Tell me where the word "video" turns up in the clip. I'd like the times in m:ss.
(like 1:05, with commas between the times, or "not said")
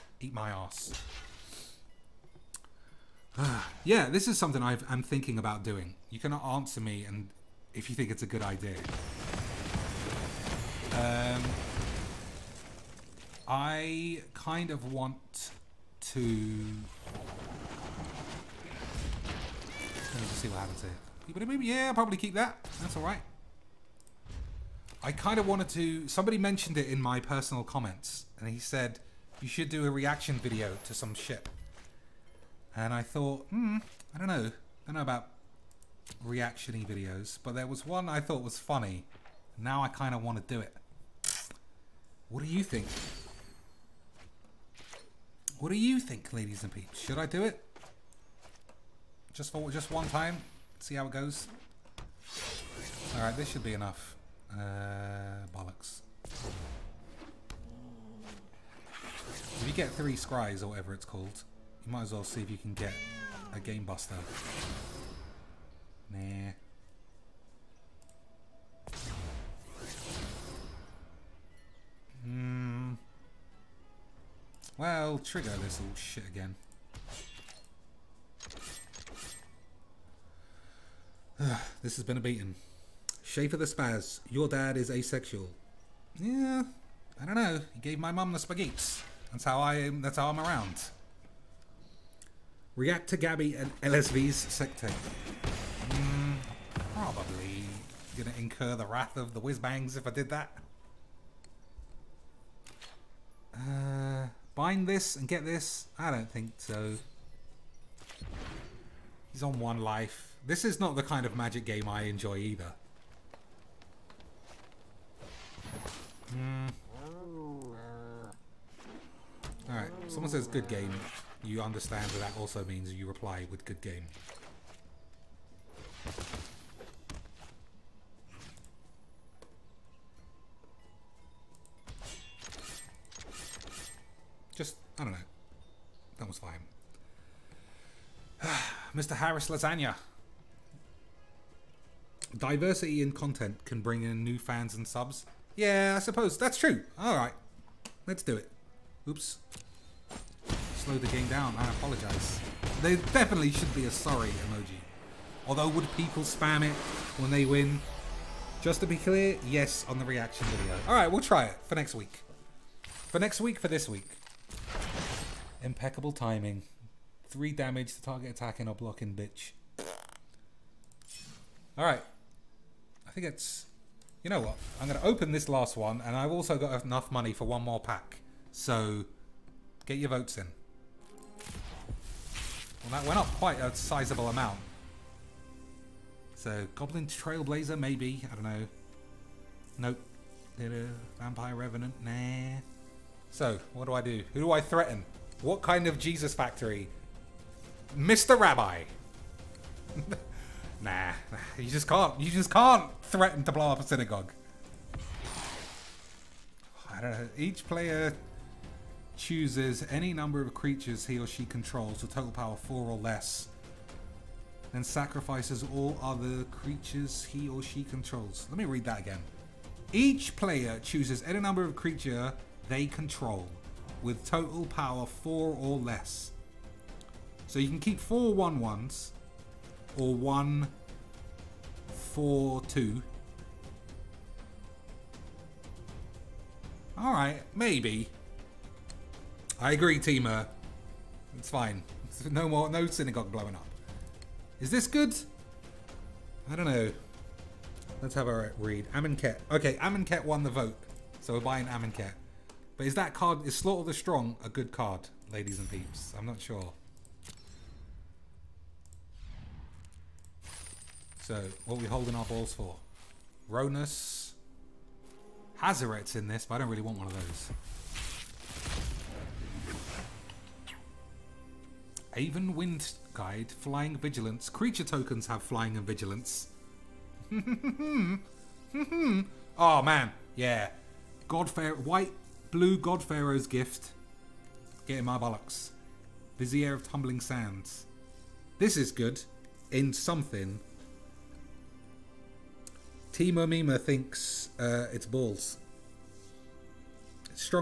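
0:30, 0:36, 2:40.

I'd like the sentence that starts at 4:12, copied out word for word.
But is that card, is Slaughter the Strong a good card, ladies and peeps?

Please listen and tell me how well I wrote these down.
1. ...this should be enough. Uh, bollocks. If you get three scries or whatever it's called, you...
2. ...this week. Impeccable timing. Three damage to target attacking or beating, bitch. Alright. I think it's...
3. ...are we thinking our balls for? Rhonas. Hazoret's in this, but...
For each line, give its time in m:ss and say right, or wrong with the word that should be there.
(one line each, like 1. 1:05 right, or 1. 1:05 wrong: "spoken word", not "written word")
1. 0:53 right
2. 2:43 wrong: "blocking", not "beating"
3. 4:21 wrong: "holding", not "thinking".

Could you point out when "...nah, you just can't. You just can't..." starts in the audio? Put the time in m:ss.
3:20.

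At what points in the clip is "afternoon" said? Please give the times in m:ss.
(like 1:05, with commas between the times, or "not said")
not said.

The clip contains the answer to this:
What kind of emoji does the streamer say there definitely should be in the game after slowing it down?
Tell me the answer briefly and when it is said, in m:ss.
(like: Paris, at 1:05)
Sorry emoji, at 2:33.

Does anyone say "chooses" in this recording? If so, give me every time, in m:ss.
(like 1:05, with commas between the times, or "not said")
3:29, 3:40.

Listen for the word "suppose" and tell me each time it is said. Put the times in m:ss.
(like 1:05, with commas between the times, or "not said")
2:25.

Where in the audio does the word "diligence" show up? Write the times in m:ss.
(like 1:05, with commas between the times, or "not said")
not said.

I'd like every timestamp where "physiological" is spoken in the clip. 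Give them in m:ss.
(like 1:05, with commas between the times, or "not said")
not said.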